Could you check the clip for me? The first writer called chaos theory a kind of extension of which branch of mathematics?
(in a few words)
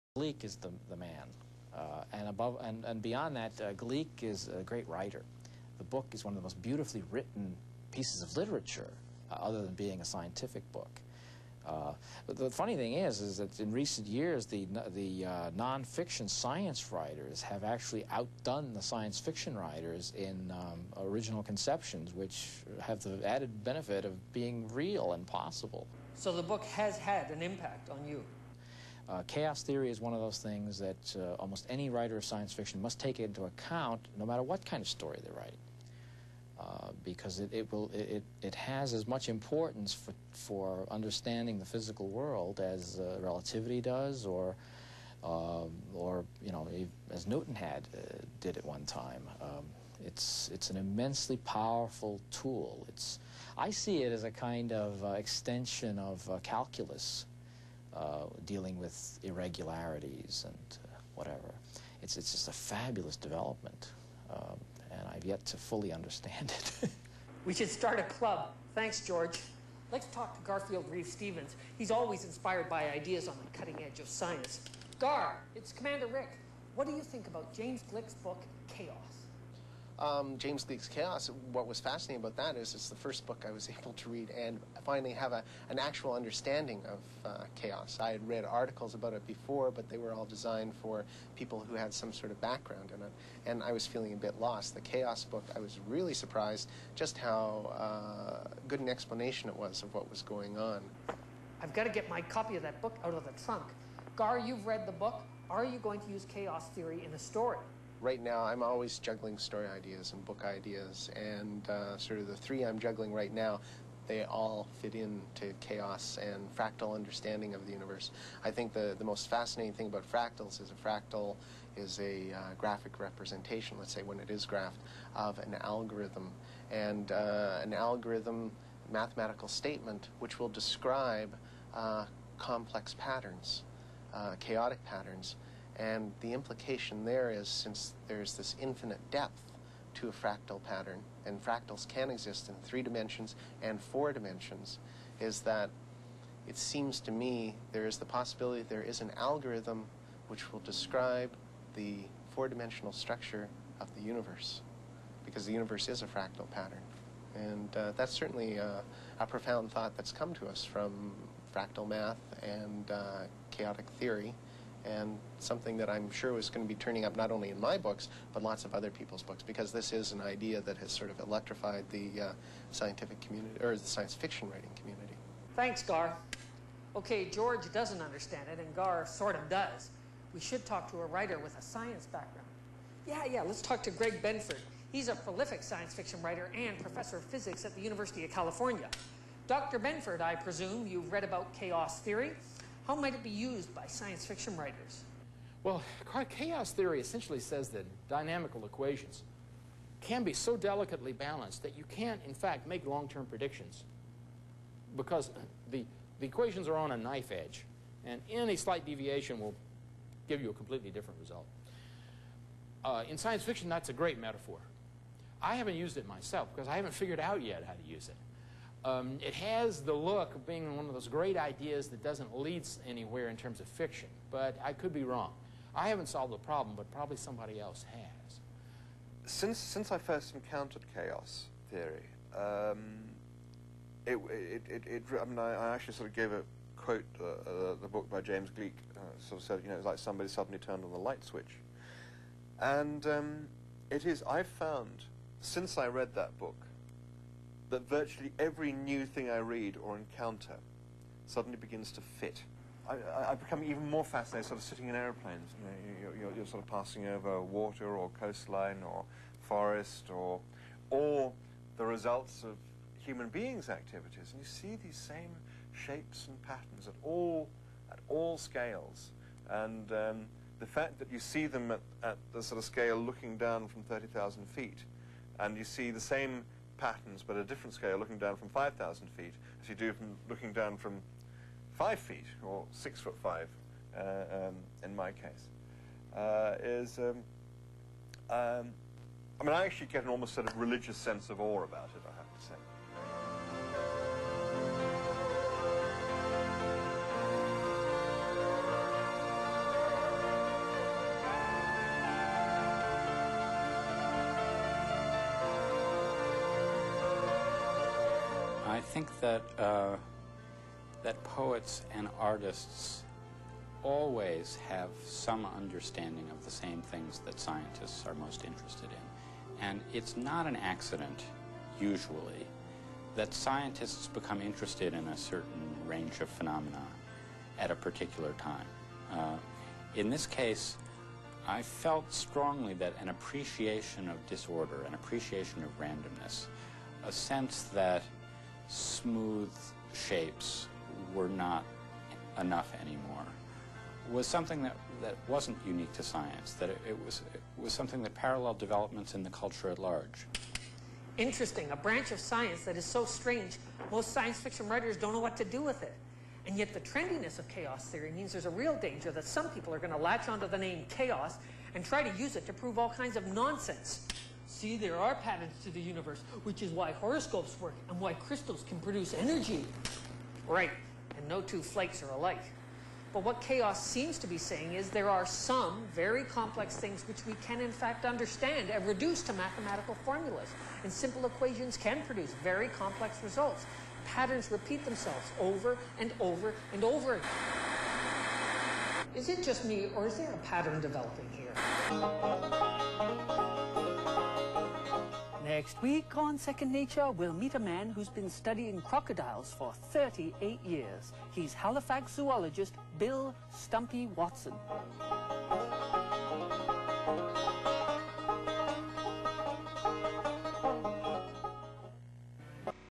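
calculus.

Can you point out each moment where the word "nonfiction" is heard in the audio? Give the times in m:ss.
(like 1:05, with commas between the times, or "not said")
0:15.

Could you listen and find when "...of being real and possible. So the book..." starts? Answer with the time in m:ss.
0:24.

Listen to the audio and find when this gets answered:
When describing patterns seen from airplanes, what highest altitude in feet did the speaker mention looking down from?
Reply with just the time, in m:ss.
4:33.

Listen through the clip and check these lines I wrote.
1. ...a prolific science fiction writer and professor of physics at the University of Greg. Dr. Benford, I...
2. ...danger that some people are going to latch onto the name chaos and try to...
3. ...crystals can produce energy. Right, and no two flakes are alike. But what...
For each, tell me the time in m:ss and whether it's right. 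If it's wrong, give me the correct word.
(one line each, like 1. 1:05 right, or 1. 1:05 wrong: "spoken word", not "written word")
1. 3:05 wrong: "California", not "Greg"
2. 5:58 right
3. 6:08 right.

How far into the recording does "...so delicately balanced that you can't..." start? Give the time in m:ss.
3:20.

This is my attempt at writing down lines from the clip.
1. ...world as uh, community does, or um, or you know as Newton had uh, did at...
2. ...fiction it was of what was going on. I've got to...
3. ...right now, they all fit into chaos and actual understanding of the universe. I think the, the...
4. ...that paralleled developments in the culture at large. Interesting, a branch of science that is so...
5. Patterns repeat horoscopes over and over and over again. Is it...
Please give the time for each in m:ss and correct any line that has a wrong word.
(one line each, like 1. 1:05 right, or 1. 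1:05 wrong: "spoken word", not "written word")
1. 0:42 wrong: "relativity", not "community"
2. 1:38 wrong: "explanation", not "fiction"
3. 1:53 wrong: "fractal", not "actual"
4. 5:48 right
5. 6:24 wrong: "themselves", not "horoscopes".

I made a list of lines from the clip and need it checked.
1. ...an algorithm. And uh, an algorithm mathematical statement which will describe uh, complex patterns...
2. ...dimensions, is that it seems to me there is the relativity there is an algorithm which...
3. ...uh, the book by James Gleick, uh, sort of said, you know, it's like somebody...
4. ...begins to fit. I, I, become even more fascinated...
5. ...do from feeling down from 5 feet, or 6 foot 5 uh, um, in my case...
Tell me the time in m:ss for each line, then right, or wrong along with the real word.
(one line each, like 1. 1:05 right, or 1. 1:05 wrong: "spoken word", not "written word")
1. 2:05 right
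2. 2:24 wrong: "possibility", not "relativity"
3. 3:57 right
4. 4:11 right
5. 4:39 wrong: "looking", not "feeling".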